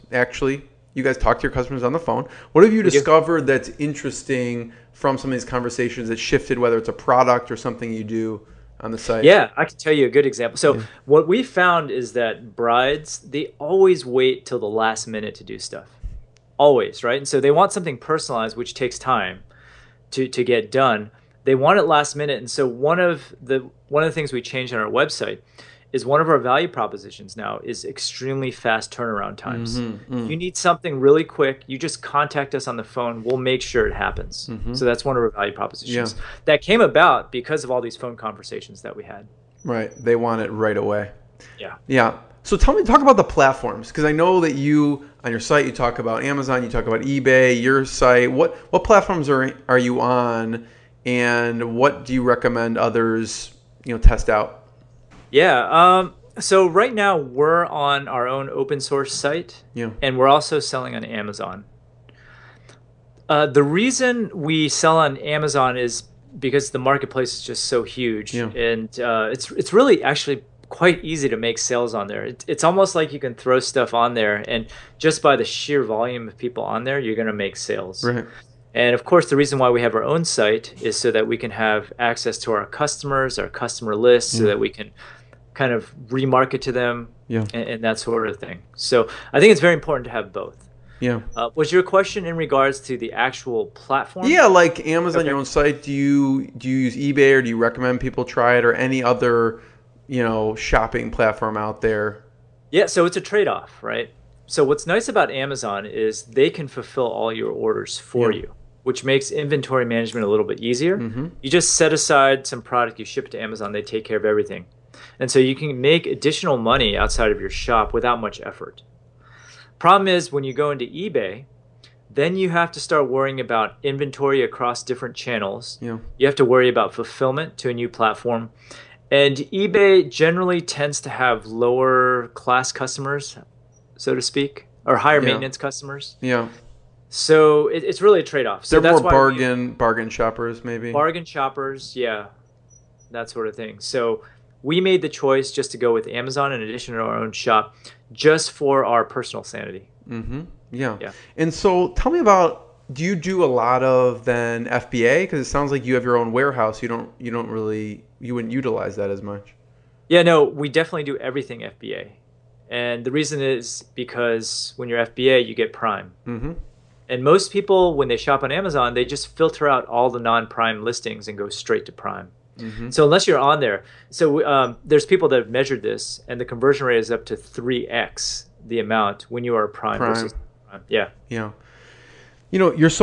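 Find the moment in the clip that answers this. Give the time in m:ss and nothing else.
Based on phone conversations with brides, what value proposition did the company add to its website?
0:27.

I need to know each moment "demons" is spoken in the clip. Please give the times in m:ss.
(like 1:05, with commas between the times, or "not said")
not said.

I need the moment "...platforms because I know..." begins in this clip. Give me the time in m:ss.
0:43.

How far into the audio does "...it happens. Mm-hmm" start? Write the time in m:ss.
0:33.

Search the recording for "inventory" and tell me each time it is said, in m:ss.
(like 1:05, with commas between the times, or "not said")
1:49, 2:03.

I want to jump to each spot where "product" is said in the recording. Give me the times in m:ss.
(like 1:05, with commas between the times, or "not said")
0:06, 1:52.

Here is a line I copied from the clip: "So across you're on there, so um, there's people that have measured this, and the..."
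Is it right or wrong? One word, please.
wrong.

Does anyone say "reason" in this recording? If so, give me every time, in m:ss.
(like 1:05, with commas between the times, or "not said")
1:03, 1:19, 2:43.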